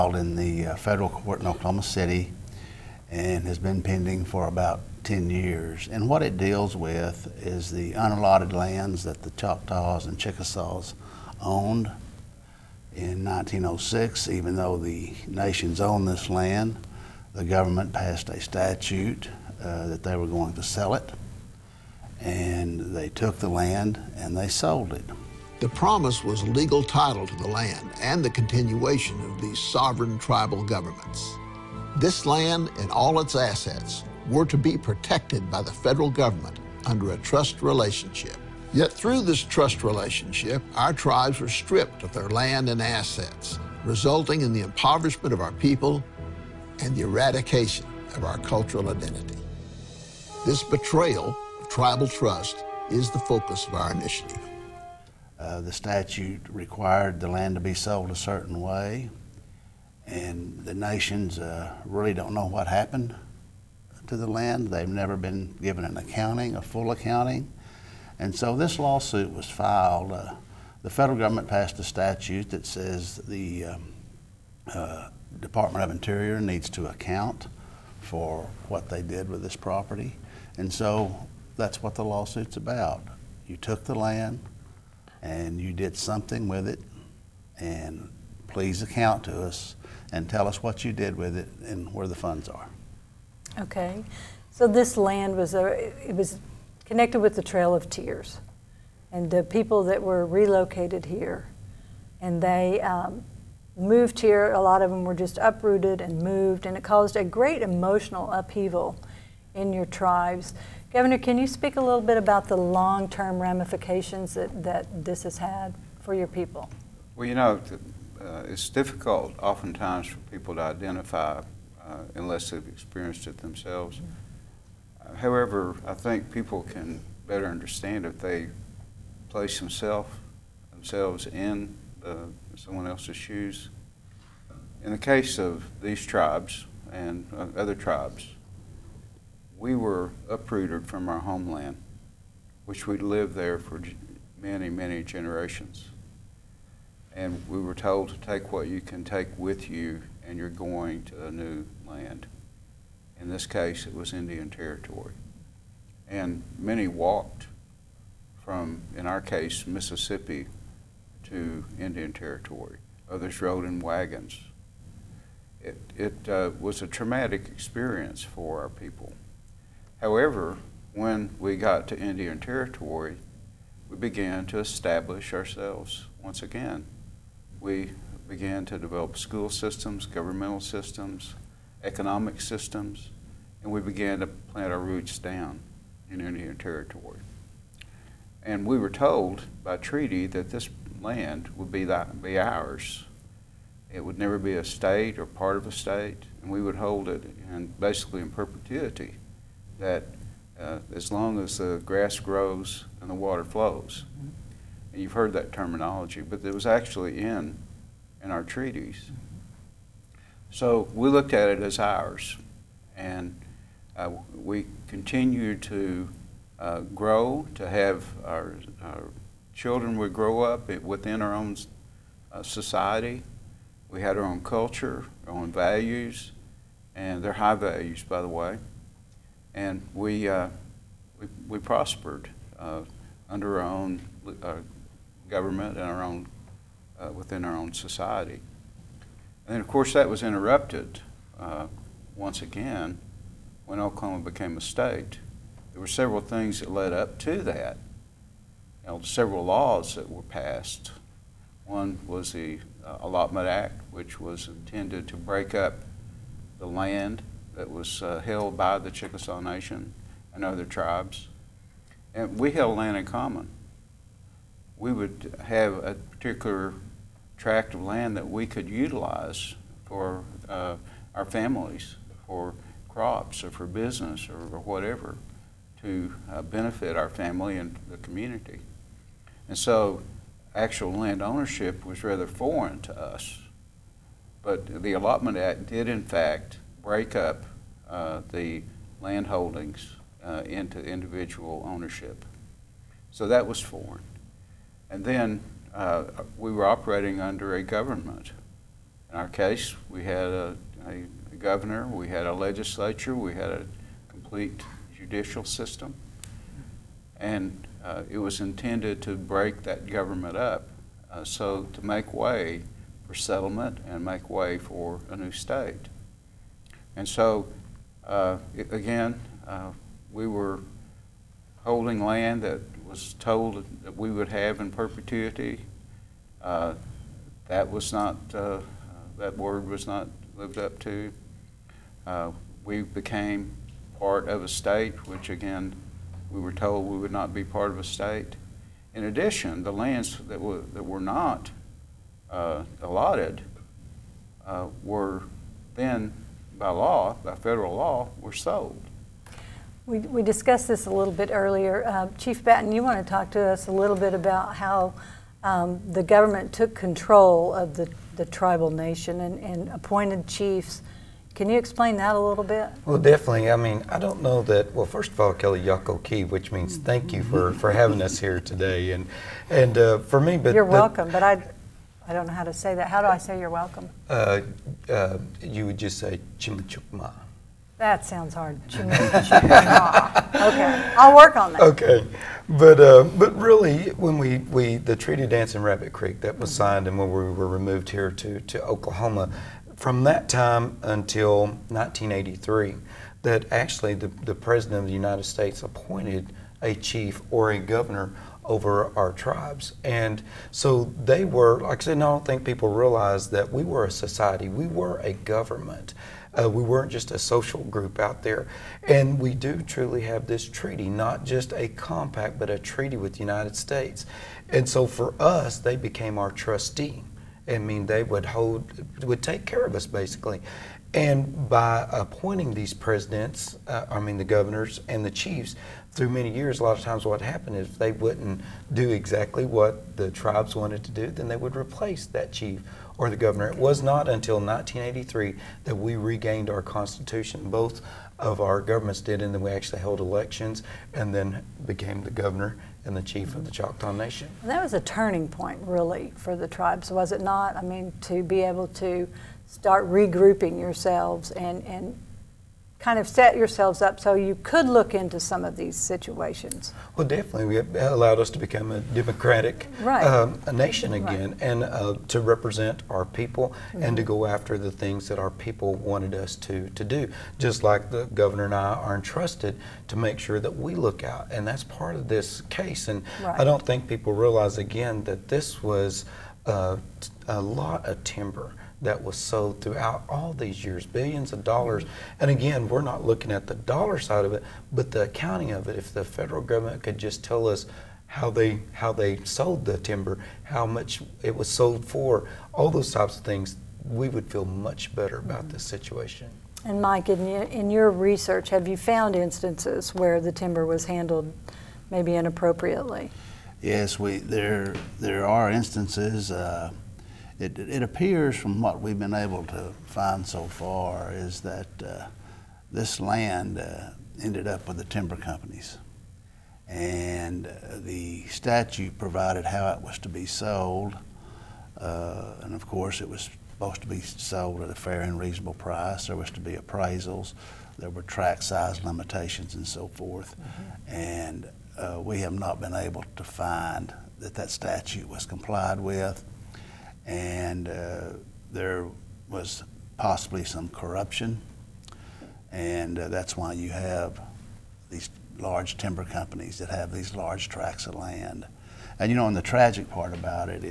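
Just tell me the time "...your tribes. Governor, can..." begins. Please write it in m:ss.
1:49.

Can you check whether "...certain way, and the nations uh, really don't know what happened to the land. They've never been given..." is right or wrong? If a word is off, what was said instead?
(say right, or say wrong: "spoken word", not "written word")
right.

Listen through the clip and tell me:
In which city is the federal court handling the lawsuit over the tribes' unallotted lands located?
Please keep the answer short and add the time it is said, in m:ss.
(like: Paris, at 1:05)
Oklahoma City, at 0:01.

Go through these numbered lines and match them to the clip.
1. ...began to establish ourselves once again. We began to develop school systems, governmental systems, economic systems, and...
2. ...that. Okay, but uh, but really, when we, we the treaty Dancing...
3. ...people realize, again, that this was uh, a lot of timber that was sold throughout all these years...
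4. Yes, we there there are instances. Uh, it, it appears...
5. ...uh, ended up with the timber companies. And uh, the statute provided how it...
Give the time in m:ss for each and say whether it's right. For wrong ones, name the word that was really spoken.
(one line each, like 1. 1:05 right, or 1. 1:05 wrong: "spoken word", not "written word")
1. 2:53 right
2. 6:21 right
3. 7:53 right
4. 8:23 right
5. 8:33 right.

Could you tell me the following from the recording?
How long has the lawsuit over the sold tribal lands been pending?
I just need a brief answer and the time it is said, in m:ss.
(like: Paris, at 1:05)
about 10 years, at 0:04.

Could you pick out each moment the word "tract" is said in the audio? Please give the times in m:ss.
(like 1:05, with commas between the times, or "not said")
4:27, 8:48, 9:07.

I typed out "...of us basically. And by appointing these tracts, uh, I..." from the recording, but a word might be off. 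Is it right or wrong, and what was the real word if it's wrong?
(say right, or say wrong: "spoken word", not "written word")
wrong: "presidents", not "tracts".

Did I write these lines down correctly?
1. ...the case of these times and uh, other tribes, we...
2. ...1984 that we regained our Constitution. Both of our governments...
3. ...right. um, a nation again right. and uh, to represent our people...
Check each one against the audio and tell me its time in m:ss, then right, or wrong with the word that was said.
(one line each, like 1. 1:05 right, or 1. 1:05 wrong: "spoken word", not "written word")
1. 2:14 wrong: "tribes", not "times"
2. 7:14 wrong: "1983", not "1984"
3. 7:39 right.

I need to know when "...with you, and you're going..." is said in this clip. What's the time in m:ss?
2:29.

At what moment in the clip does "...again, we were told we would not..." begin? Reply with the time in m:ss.
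5:35.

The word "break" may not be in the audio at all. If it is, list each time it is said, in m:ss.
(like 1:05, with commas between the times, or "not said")
4:15, 4:46, 5:09.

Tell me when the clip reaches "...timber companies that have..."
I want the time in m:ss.
9:05.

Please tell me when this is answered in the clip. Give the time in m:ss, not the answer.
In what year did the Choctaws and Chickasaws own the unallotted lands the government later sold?
0:13.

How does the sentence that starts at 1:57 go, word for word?
Well, you know, uh, it's difficult oftentimes for people to identify uh, unless they've experienced it themselves.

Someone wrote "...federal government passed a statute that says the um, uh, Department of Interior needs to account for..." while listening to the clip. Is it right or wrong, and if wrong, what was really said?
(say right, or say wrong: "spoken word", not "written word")
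right.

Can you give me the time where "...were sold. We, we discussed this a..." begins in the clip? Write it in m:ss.
5:48.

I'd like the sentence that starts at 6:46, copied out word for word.
Uh, we weren't just a social group out there.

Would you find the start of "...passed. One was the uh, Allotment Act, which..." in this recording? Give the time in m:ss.
4:10.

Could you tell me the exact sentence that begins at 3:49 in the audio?
And we, uh, we, we, prospered uh, under our own uh, government and our own, within our own society.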